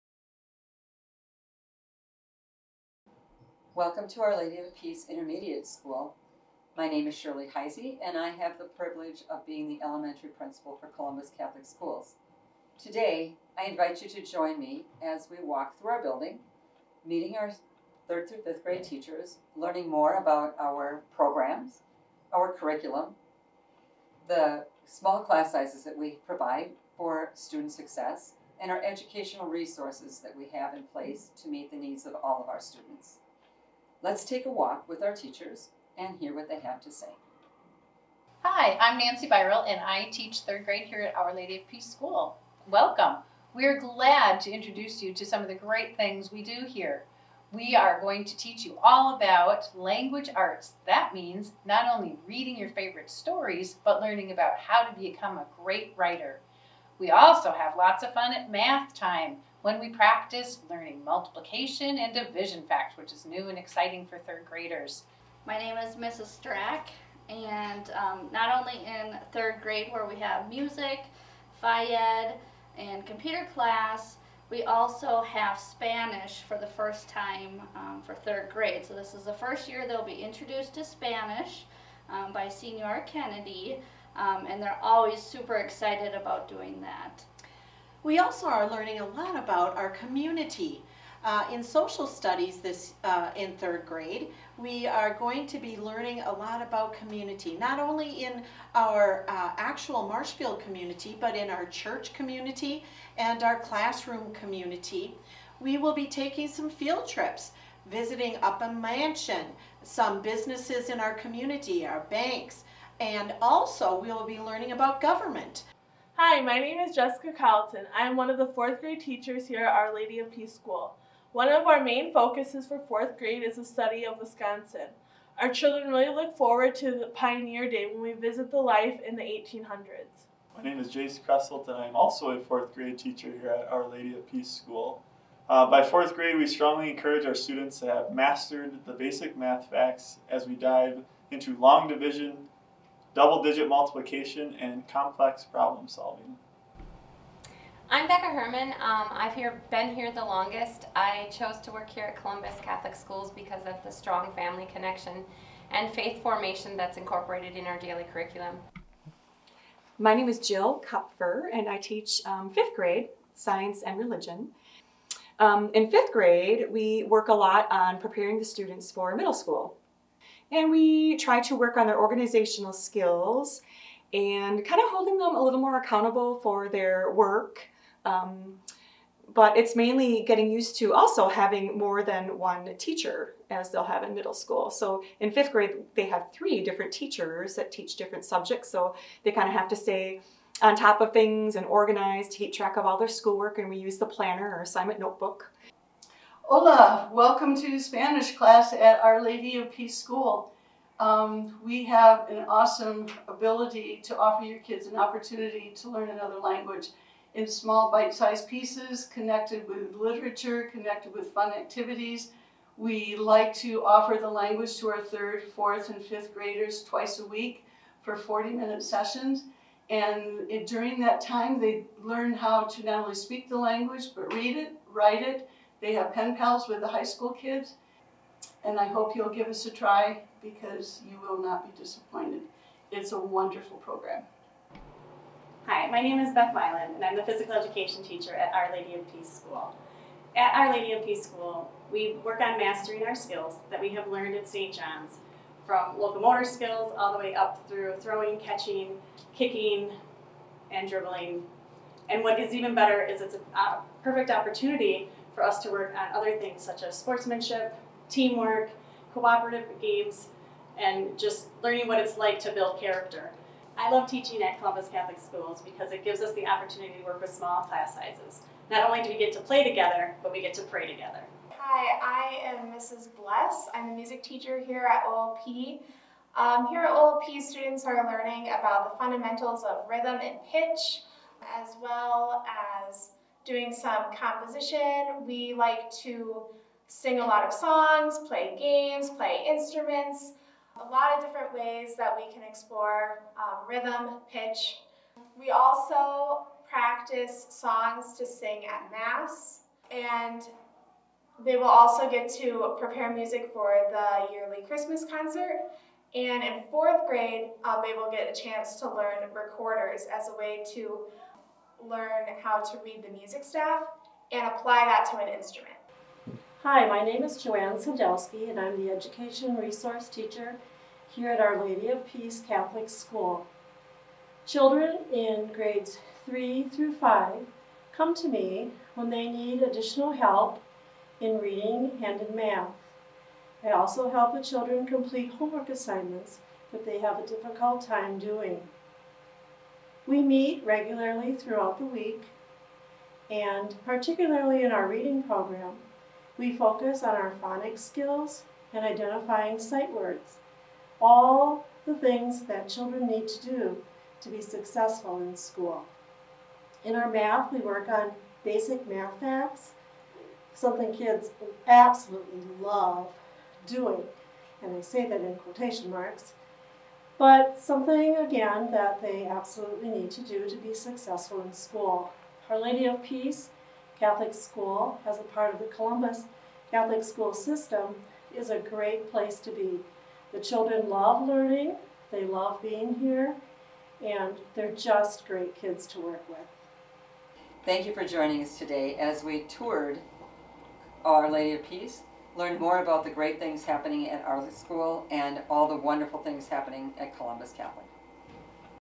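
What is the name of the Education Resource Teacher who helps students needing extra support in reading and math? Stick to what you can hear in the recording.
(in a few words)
Joanne Sadowski.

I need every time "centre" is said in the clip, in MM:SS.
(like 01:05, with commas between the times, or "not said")
not said.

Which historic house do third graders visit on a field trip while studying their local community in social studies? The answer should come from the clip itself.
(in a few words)
Upham Mansion.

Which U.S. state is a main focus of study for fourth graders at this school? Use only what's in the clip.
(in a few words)
Wisconsin.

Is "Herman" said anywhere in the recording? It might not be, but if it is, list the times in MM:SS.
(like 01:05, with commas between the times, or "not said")
02:28.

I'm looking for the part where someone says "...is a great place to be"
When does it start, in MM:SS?
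06:18.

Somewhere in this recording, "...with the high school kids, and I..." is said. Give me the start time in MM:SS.
03:46.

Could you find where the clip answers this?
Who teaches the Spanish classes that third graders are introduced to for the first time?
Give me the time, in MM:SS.
01:22.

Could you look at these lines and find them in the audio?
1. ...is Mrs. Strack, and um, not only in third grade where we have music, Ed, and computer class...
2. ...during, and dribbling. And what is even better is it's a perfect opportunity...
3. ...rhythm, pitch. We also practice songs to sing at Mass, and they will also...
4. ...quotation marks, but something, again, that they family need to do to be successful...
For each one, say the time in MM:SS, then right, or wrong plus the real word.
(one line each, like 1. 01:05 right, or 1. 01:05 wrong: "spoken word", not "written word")
1. 01:05 right
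2. 04:09 wrong: "kicking", not "during"
3. 04:53 right
4. 06:05 wrong: "absolutely", not "family".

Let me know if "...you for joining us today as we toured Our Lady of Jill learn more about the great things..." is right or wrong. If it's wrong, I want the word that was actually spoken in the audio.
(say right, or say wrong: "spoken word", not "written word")
wrong: "Peace", not "Jill".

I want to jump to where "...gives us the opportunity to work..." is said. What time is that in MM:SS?
04:26.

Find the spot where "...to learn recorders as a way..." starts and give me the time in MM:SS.
05:08.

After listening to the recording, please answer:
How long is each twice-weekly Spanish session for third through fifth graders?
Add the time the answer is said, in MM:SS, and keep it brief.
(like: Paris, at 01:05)
40 minutes, at 03:38.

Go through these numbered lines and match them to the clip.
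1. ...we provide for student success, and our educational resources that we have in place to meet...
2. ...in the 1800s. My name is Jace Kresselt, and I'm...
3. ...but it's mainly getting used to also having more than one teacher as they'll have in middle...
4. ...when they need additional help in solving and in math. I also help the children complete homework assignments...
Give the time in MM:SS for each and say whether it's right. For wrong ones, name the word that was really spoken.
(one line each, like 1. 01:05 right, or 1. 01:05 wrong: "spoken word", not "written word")
1. 00:25 right
2. 02:09 right
3. 02:59 right
4. 05:28 wrong: "reading", not "solving".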